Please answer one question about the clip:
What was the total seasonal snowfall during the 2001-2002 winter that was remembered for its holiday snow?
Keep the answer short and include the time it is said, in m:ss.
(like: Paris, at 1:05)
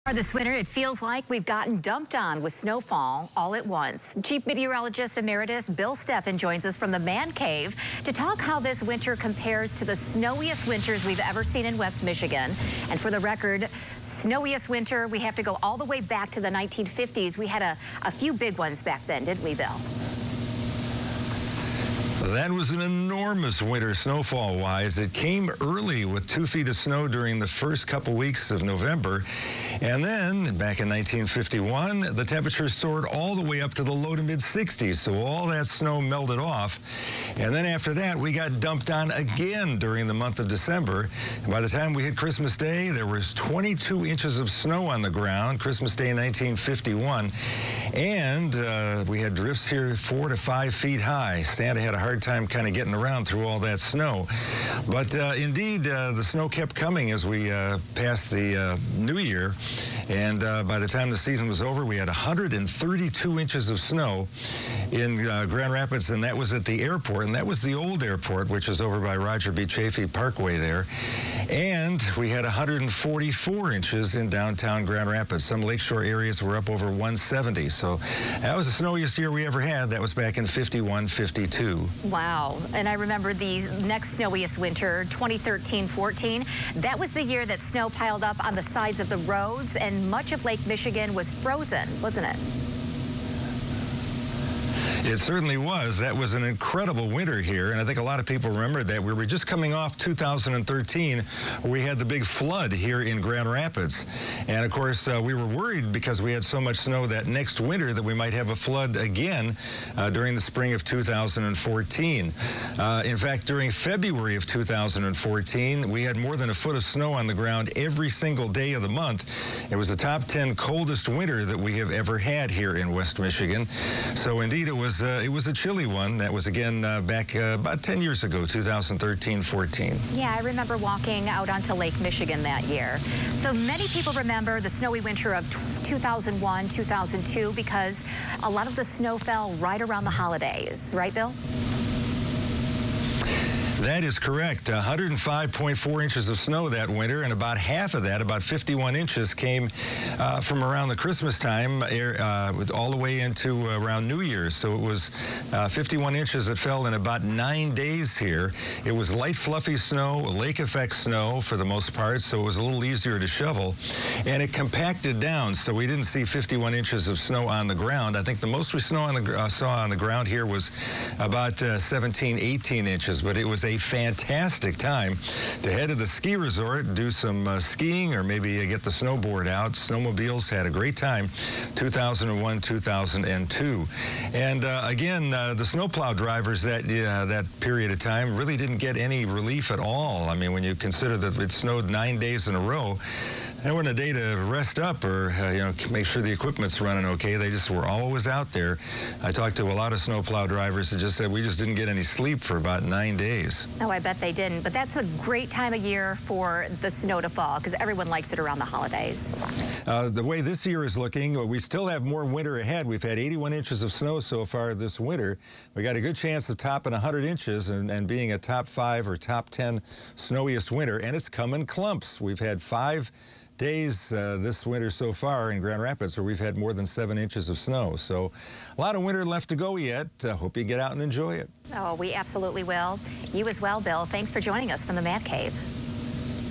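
105.4 inches, at 2:24.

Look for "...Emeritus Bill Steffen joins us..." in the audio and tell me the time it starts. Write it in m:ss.
0:05.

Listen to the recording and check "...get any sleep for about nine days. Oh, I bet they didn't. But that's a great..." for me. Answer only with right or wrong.
right.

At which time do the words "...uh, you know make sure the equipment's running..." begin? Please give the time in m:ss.
3:15.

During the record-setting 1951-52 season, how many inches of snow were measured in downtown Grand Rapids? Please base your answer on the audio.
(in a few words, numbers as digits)
144 inches.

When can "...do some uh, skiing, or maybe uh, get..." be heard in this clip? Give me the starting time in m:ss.
2:56.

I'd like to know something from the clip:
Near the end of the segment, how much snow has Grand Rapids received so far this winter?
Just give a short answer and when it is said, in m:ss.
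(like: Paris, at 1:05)
81 inches, at 3:33.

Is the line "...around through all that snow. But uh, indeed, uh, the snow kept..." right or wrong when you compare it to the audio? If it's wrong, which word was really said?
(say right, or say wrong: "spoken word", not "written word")
right.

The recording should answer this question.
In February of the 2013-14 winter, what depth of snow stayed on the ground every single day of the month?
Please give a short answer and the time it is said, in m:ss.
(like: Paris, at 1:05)
More than a foot, at 1:56.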